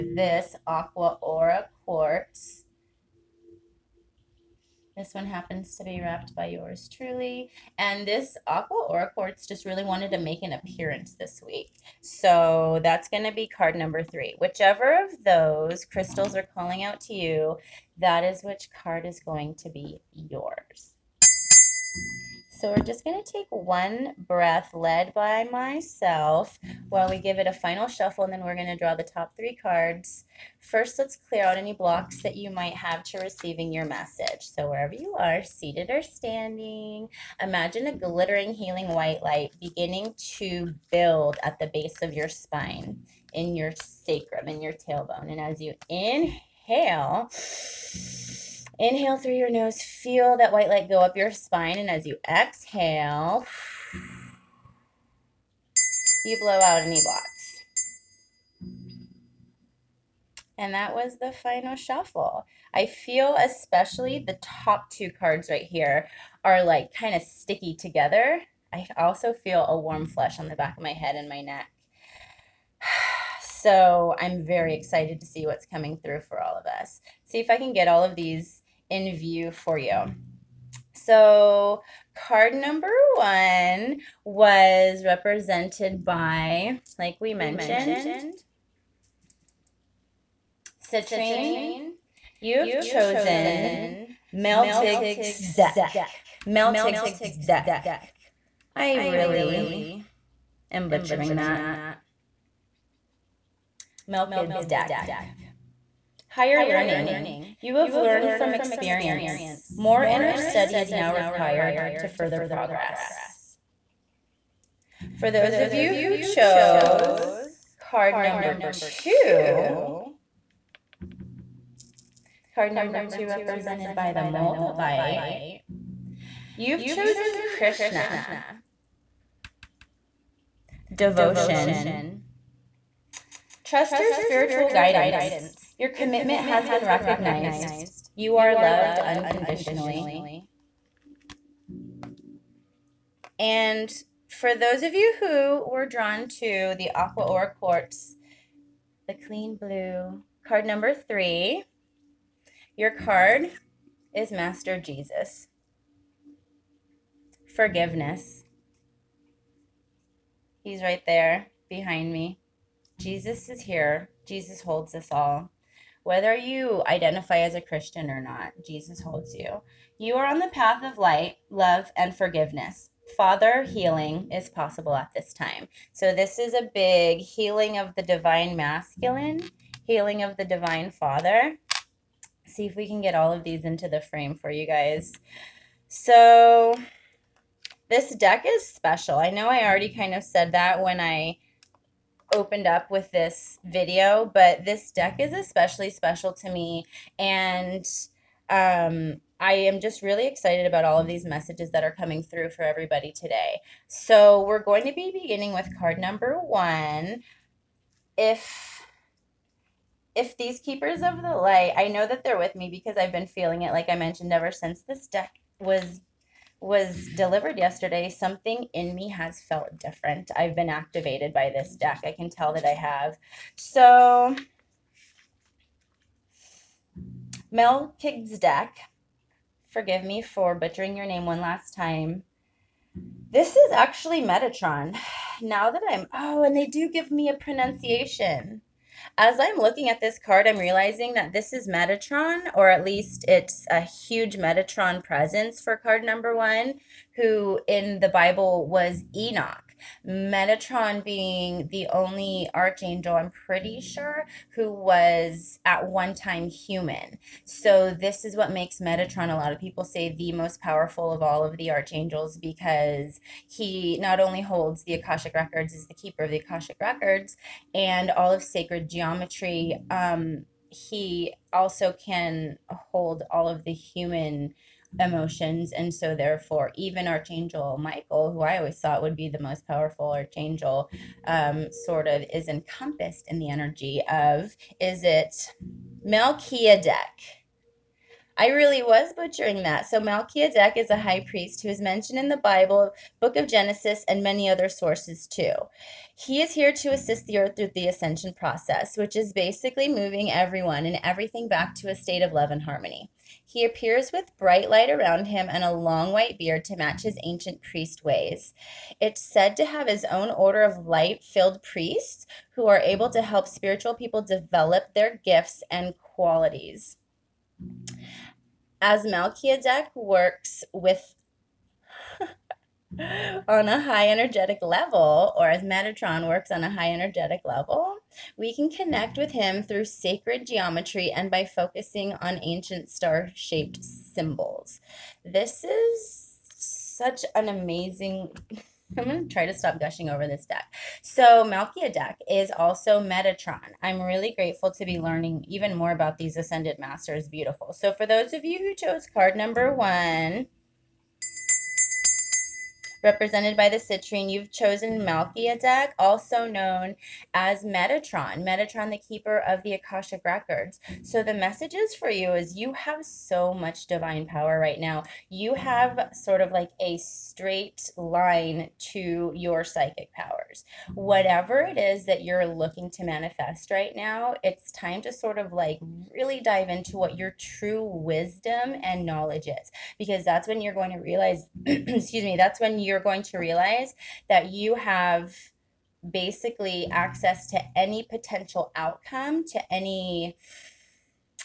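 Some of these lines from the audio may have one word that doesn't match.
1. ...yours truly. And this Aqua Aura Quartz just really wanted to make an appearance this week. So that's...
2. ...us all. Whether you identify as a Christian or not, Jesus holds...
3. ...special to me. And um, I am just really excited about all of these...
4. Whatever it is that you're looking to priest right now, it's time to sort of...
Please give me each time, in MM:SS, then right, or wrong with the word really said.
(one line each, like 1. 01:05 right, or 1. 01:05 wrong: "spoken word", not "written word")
1. 00:06 right
2. 02:44 right
3. 03:15 right
4. 06:10 wrong: "manifest", not "priest".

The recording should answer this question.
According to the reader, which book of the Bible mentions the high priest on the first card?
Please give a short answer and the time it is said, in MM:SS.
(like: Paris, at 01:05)
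Genesis, at 04:53.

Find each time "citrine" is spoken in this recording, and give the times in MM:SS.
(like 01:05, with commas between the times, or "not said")
01:30, 05:53.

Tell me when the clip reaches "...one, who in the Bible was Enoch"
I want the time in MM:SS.
04:06.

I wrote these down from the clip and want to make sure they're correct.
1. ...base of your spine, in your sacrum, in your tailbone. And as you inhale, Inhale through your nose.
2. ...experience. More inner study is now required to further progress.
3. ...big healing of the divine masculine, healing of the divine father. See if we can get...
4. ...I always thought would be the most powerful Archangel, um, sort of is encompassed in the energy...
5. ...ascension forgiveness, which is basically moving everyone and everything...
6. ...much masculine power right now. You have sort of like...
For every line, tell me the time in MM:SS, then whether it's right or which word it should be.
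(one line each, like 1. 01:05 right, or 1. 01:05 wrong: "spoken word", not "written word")
1. 00:41 right
2. 01:48 right
3. 02:56 right
4. 04:38 right
5. 04:57 wrong: "process", not "forgiveness"
6. 06:03 wrong: "divine", not "masculine".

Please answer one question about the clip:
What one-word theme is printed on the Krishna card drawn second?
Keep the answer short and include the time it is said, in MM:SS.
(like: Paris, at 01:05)
Devotion, at 02:10.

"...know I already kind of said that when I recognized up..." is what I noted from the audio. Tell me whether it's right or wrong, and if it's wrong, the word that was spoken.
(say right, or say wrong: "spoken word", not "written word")
wrong: "opened", not "recognized".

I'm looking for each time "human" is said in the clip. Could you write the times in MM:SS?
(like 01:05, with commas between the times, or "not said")
04:16, 04:33.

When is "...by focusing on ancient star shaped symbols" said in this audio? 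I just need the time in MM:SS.
05:31.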